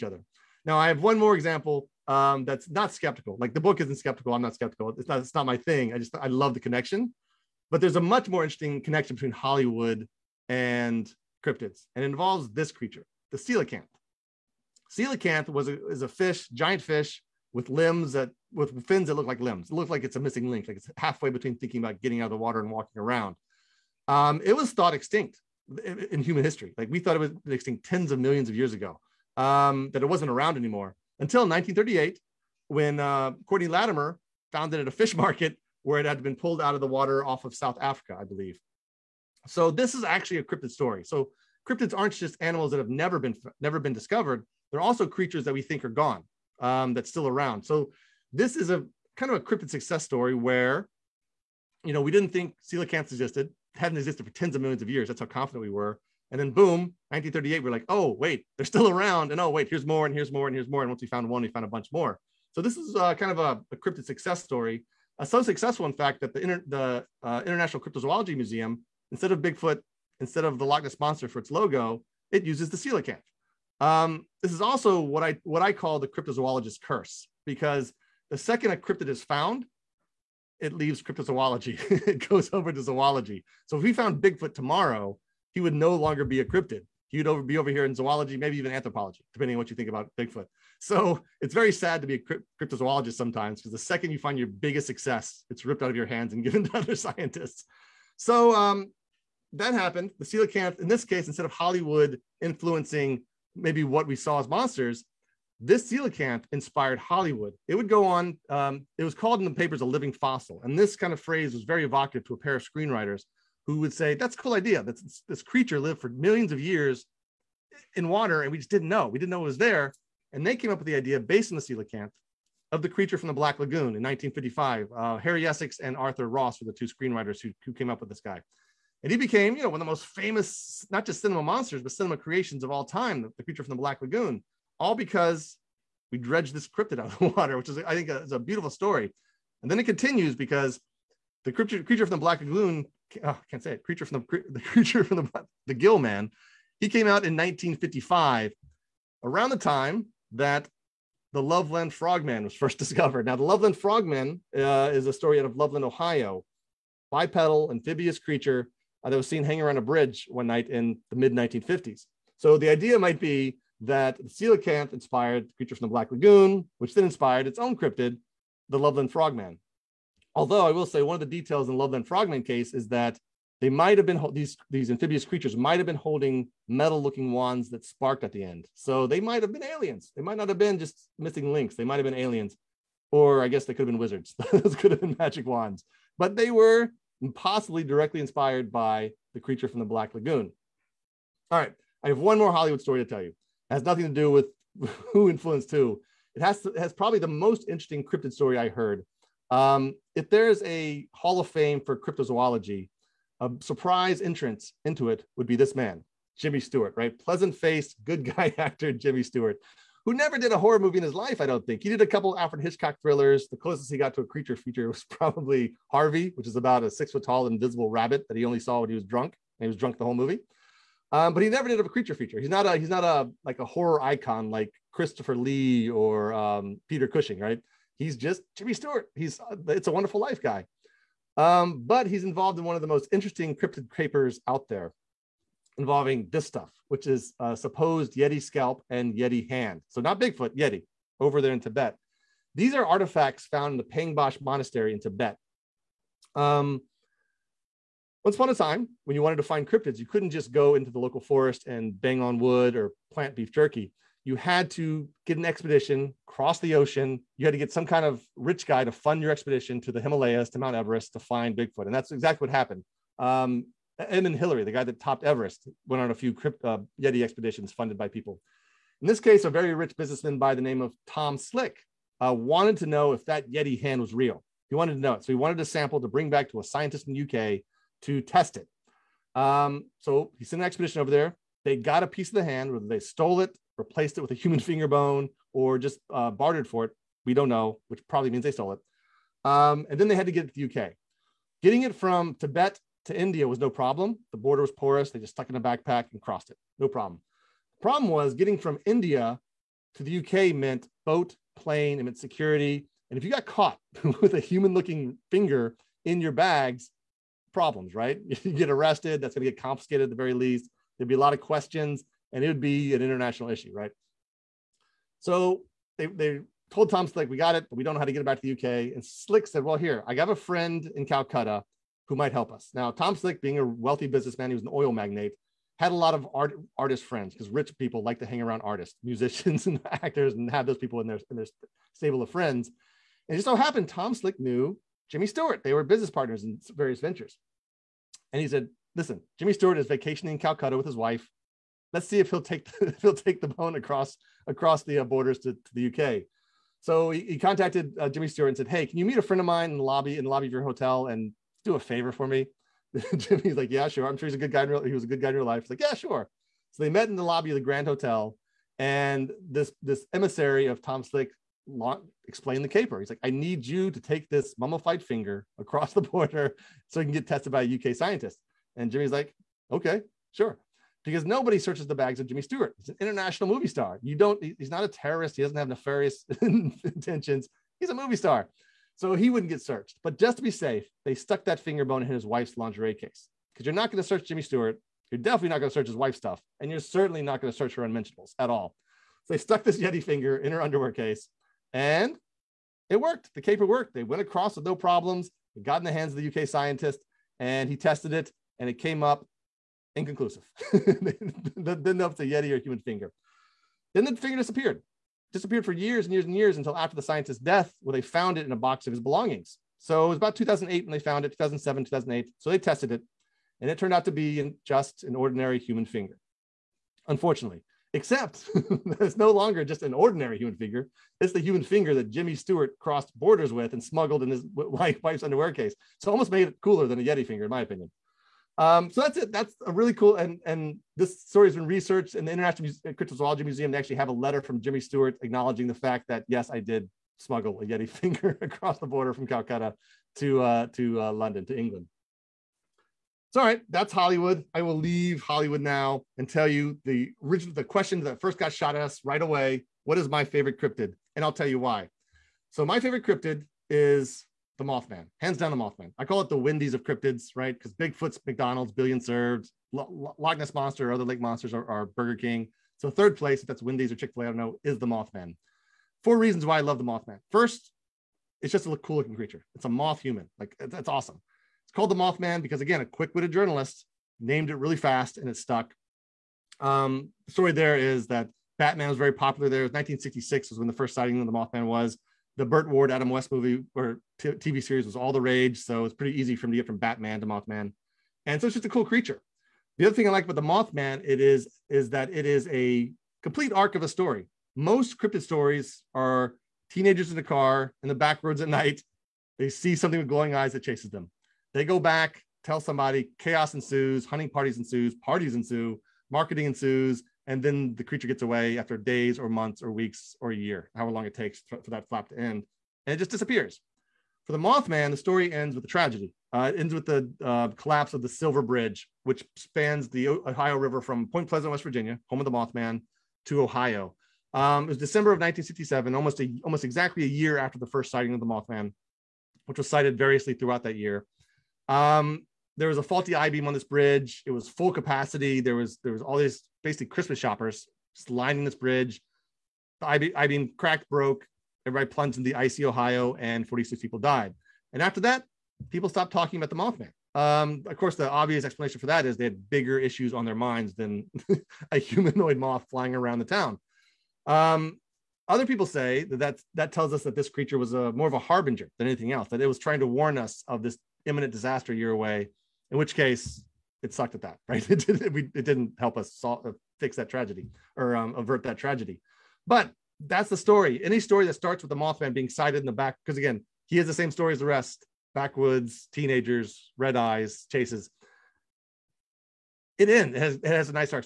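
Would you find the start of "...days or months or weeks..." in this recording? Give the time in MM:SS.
08:28.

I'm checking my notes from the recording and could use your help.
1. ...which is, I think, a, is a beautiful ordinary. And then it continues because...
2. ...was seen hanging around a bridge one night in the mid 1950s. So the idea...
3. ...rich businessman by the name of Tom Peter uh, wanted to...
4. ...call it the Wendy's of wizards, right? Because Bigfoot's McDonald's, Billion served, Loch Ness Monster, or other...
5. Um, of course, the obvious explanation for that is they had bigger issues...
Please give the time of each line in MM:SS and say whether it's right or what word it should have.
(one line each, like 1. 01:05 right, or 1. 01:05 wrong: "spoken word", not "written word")
1. 02:17 wrong: "story", not "ordinary"
2. 02:39 right
3. 04:29 wrong: "Slick", not "Peter"
4. 07:36 wrong: "cryptids", not "wizards"
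5. 09:07 right.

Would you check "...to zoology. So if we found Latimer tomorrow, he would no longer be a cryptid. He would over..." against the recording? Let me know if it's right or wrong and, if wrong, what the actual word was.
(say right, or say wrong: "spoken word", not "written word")
wrong: "Bigfoot", not "Latimer".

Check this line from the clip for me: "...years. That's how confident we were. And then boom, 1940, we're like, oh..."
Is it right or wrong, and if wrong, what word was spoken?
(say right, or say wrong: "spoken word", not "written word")
wrong: "1938", not "1940".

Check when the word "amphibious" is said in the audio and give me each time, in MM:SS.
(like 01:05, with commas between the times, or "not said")
02:37, 02:54.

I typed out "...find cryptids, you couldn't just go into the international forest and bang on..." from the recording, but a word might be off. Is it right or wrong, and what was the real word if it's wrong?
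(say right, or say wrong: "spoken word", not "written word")
wrong: "local", not "international".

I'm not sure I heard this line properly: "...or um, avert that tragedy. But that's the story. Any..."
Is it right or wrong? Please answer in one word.
right.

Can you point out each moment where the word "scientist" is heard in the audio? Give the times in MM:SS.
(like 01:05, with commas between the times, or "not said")
01:36, 04:36, 06:07, 06:36, 06:47.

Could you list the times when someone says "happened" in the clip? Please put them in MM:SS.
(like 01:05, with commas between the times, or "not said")
01:39, 04:22, 05:33.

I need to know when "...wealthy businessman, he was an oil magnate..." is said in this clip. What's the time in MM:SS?
05:23.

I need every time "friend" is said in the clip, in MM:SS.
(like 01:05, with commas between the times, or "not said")
05:20, 05:27, 05:32, 05:49.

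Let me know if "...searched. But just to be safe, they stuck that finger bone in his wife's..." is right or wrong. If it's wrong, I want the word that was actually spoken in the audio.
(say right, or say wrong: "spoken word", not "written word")
right.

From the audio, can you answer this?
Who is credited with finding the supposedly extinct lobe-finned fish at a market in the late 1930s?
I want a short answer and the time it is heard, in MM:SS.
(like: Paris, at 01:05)
Courtney Latimer, at 00:33.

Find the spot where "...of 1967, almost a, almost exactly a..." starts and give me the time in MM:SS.
08:45.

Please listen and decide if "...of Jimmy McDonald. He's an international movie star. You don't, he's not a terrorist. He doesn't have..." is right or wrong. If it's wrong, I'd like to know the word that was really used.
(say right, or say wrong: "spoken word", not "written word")
wrong: "Stewart", not "McDonald".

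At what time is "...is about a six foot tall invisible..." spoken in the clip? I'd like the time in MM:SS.
03:36.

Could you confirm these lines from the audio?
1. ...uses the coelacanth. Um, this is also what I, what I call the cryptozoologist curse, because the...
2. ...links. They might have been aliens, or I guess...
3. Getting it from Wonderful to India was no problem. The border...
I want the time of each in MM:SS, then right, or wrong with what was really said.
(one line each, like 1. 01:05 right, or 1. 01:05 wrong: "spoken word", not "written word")
1. 01:12 right
2. 03:01 right
3. 04:51 wrong: "Tibet", not "Wonderful".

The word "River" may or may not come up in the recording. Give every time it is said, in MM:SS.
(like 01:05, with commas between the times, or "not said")
08:40.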